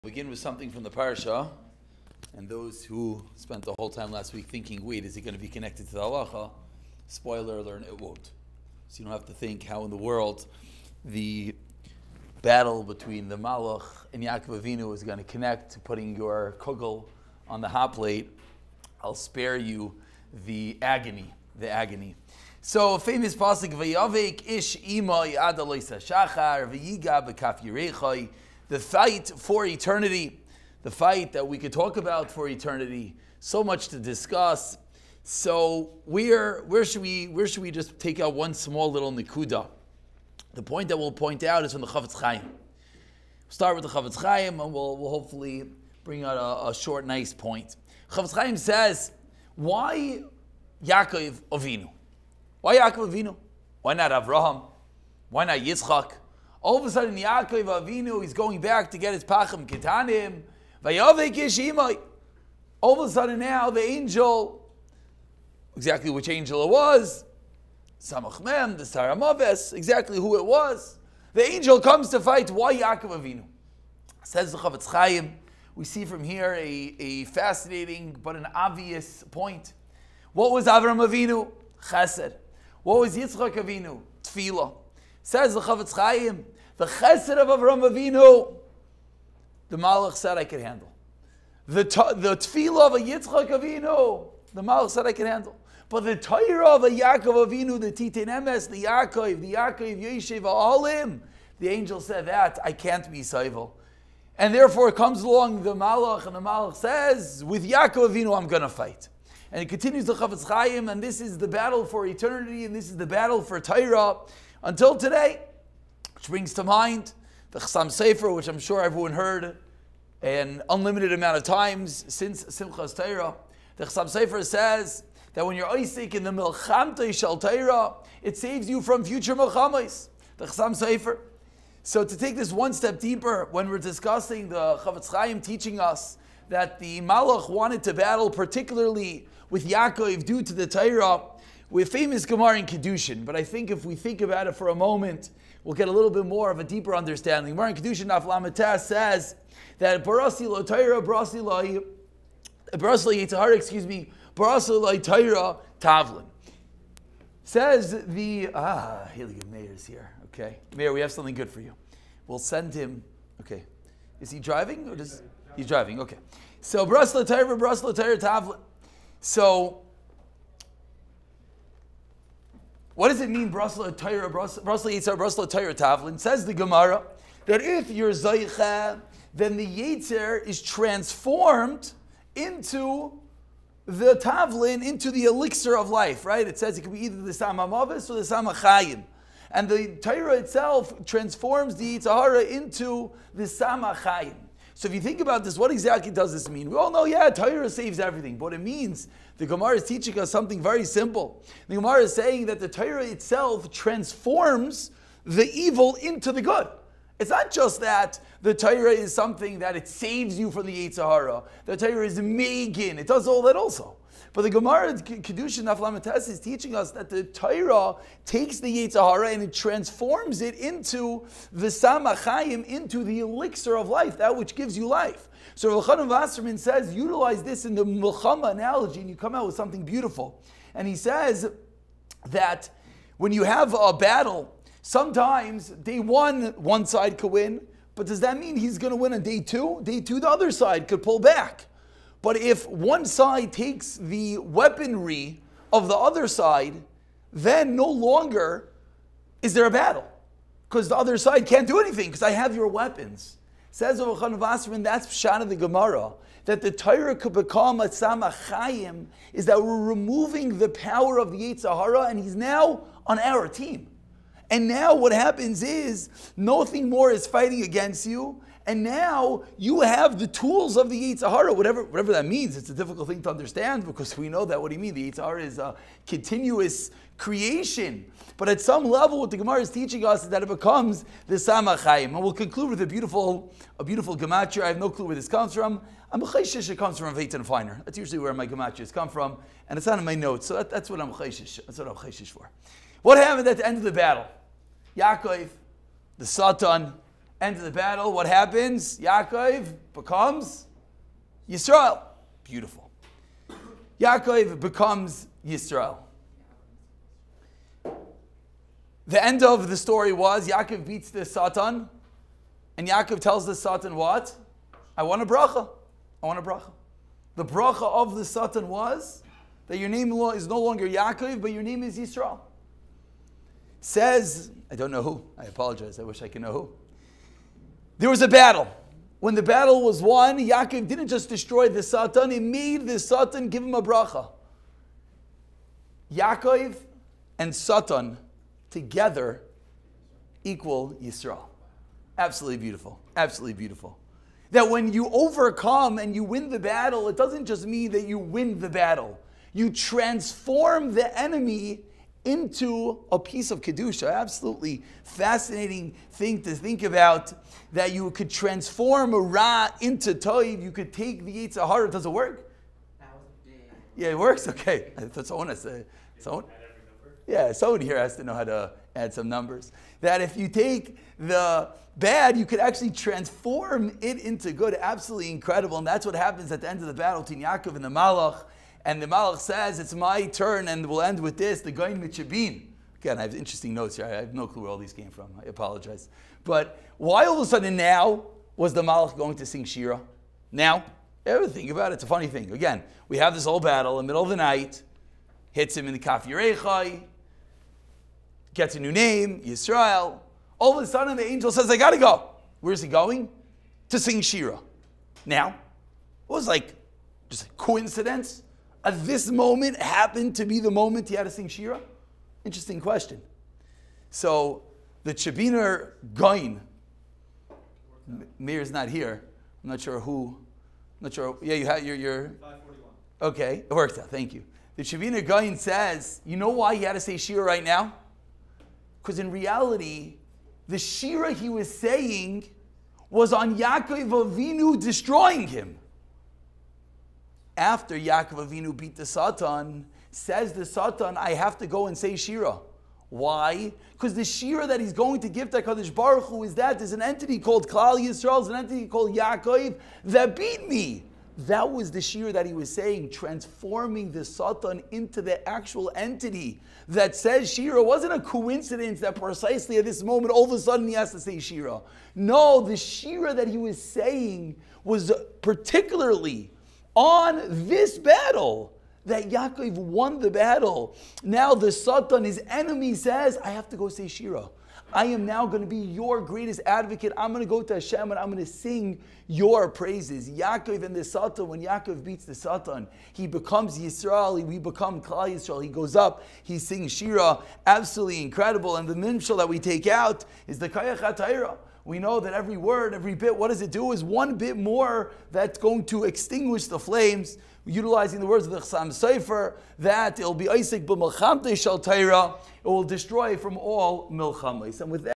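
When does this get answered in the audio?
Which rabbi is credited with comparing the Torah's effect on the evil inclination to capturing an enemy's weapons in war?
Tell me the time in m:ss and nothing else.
3:45.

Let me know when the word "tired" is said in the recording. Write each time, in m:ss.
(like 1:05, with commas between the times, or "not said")
not said.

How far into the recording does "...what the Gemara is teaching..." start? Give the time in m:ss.
4:39.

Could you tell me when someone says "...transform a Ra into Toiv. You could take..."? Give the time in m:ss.
5:58.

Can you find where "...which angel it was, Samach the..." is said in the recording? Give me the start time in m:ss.
1:06.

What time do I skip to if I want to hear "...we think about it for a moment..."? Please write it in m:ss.
2:23.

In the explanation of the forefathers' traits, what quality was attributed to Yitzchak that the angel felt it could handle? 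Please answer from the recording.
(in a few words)
Tefillah.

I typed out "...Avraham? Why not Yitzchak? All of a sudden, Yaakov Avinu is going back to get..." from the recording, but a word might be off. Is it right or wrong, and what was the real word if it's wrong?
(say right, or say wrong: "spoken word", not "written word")
right.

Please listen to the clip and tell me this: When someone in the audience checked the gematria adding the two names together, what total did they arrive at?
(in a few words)
541.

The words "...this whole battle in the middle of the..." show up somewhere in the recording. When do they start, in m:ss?
6:33.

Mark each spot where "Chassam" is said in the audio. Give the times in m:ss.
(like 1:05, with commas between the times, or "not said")
1:57, 2:03, 2:10, 8:18.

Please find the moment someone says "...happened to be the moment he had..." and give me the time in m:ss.
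6:49.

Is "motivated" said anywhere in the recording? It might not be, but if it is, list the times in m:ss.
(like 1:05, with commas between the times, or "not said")
not said.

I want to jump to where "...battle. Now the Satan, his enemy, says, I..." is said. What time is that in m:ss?
7:50.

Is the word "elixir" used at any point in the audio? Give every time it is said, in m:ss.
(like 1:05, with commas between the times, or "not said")
3:05, 3:43.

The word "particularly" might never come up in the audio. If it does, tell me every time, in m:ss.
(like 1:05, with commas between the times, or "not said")
2:18, 7:45.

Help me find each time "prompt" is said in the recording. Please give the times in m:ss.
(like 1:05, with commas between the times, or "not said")
not said.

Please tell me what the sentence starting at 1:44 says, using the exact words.
And therefore comes along the Malach, and the Malach says, with Yaakov Avinu I'm going to fight.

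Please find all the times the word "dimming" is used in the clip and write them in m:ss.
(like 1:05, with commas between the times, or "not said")
not said.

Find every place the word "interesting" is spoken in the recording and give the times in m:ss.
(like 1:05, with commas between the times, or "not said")
6:23, 6:52.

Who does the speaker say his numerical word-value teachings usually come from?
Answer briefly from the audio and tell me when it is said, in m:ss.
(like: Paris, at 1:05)
Veitan Feiner, at 4:47.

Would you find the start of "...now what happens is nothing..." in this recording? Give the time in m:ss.
4:24.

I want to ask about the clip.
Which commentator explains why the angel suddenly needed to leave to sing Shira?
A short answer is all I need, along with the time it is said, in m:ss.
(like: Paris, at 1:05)
The Chavina Goin, at 7:04.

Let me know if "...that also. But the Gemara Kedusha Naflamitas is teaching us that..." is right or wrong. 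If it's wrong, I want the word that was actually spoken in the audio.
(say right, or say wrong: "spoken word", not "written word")
right.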